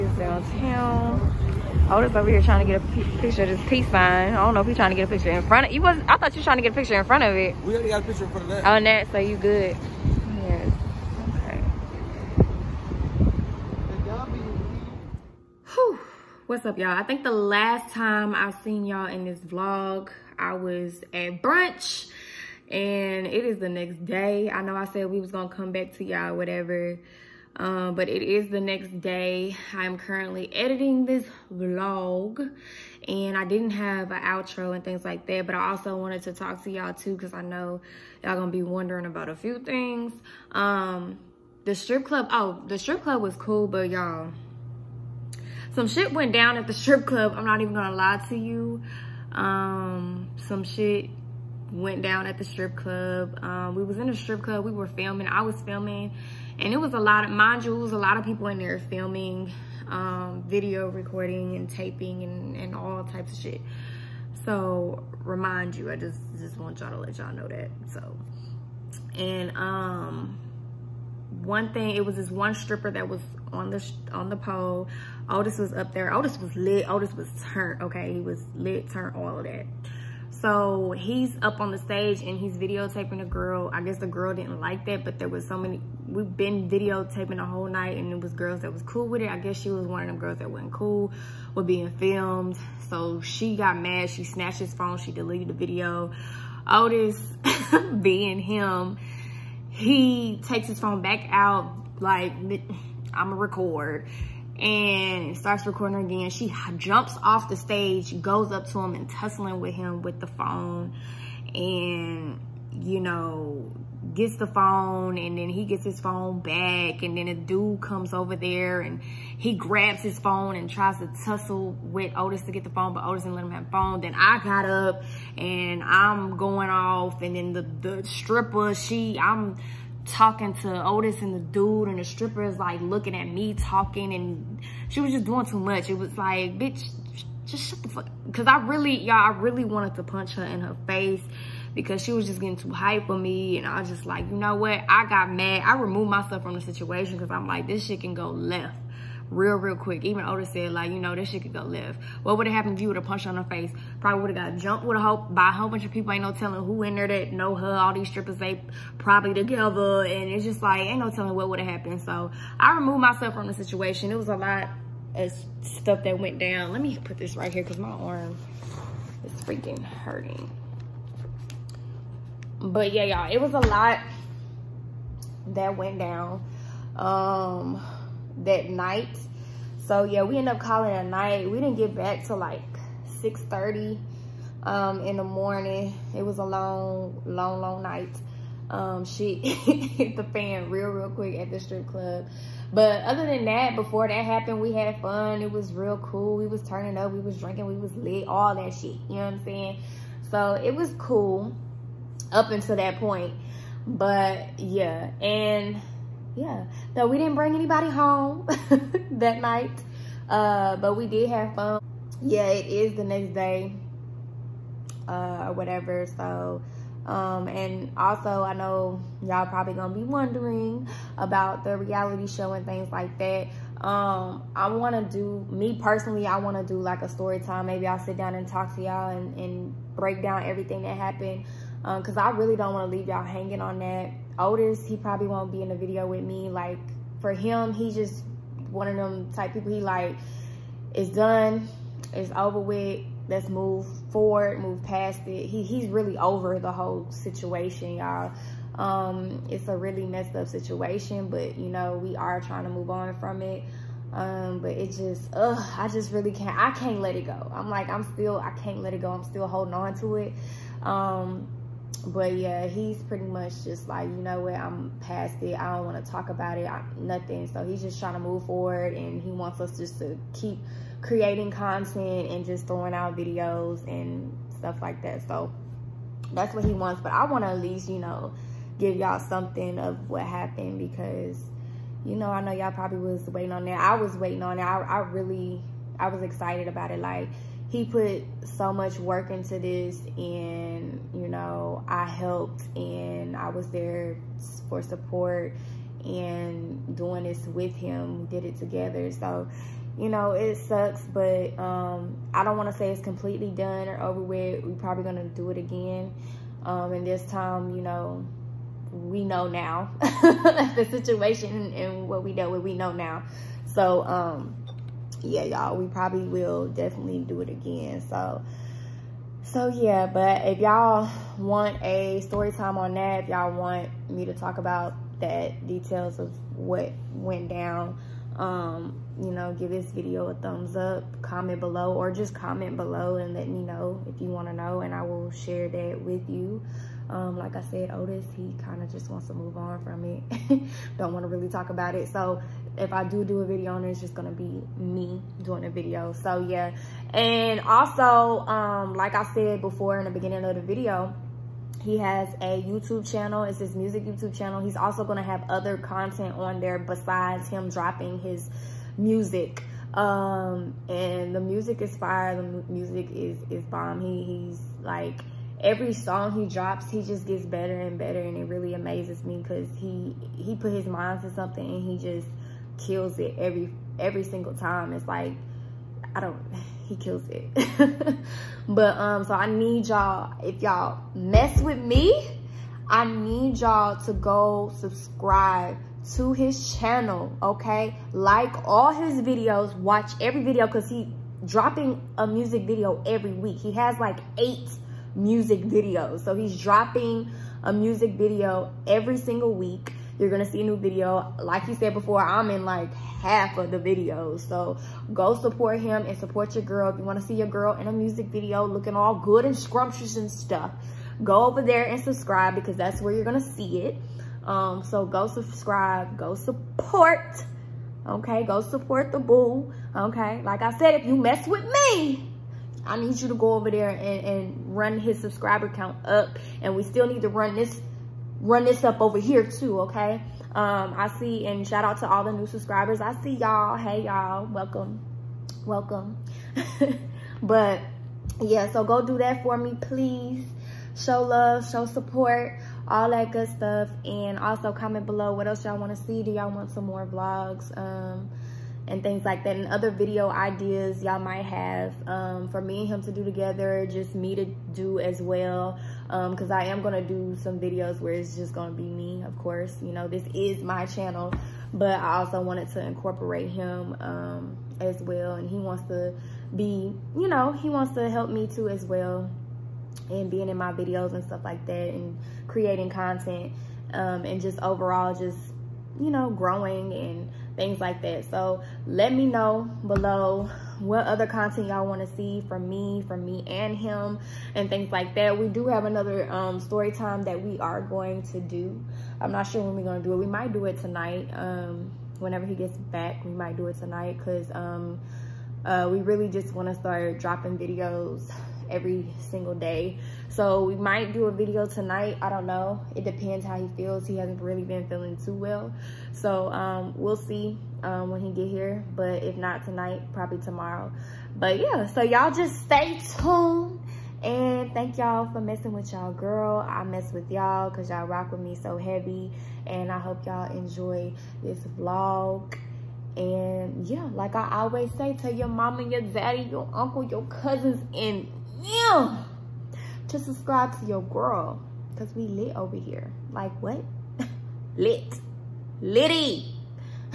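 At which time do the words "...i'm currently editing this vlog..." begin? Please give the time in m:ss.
0:29.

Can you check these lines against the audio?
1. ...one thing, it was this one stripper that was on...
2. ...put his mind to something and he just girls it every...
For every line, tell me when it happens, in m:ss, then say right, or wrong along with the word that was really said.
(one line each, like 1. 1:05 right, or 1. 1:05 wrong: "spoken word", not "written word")
1. 1:11 right
2. 6:10 wrong: "kills", not "girls".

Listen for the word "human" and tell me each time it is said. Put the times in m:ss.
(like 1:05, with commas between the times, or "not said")
not said.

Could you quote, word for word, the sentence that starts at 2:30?
Even Otis said, like, you know, this shit could go left.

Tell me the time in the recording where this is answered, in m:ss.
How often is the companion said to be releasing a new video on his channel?
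6:33.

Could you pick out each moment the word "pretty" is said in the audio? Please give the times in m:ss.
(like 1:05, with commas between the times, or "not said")
4:23.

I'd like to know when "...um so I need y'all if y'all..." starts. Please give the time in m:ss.
6:18.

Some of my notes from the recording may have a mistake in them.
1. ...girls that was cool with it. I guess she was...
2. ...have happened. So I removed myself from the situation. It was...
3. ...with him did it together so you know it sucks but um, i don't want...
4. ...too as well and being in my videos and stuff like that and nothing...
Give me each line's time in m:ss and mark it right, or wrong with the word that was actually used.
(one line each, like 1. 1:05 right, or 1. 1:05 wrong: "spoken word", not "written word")
1. 1:28 right
2. 2:41 right
3. 4:57 right
4. 7:48 wrong: "creating", not "nothing".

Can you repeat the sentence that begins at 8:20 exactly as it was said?
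So we might do a video tonight.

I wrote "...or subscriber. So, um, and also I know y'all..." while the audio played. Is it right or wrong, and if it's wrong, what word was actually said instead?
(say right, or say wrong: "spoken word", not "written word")
wrong: "whatever", not "subscriber".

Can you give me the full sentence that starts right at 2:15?
It was like, bitch, just shut the fuck.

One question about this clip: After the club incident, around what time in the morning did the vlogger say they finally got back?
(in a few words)
6:30.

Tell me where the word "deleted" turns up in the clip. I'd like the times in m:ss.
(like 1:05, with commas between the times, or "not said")
1:35.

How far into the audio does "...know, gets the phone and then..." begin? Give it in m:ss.
1:53.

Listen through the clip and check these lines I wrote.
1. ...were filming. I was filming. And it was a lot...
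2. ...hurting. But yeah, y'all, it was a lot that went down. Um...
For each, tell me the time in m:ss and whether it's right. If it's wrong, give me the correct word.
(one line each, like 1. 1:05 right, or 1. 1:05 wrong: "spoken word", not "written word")
1. 0:54 right
2. 2:49 right.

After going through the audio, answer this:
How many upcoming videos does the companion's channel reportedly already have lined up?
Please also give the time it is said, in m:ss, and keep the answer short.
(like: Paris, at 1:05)
8, at 6:34.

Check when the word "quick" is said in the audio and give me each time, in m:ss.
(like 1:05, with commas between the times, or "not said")
2:29, 3:11.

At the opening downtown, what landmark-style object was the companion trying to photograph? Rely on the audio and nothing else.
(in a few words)
Peace sign.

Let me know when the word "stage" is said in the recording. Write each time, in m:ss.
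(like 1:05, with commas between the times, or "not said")
1:21, 1:47.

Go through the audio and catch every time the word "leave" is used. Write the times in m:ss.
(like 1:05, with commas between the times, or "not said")
3:52.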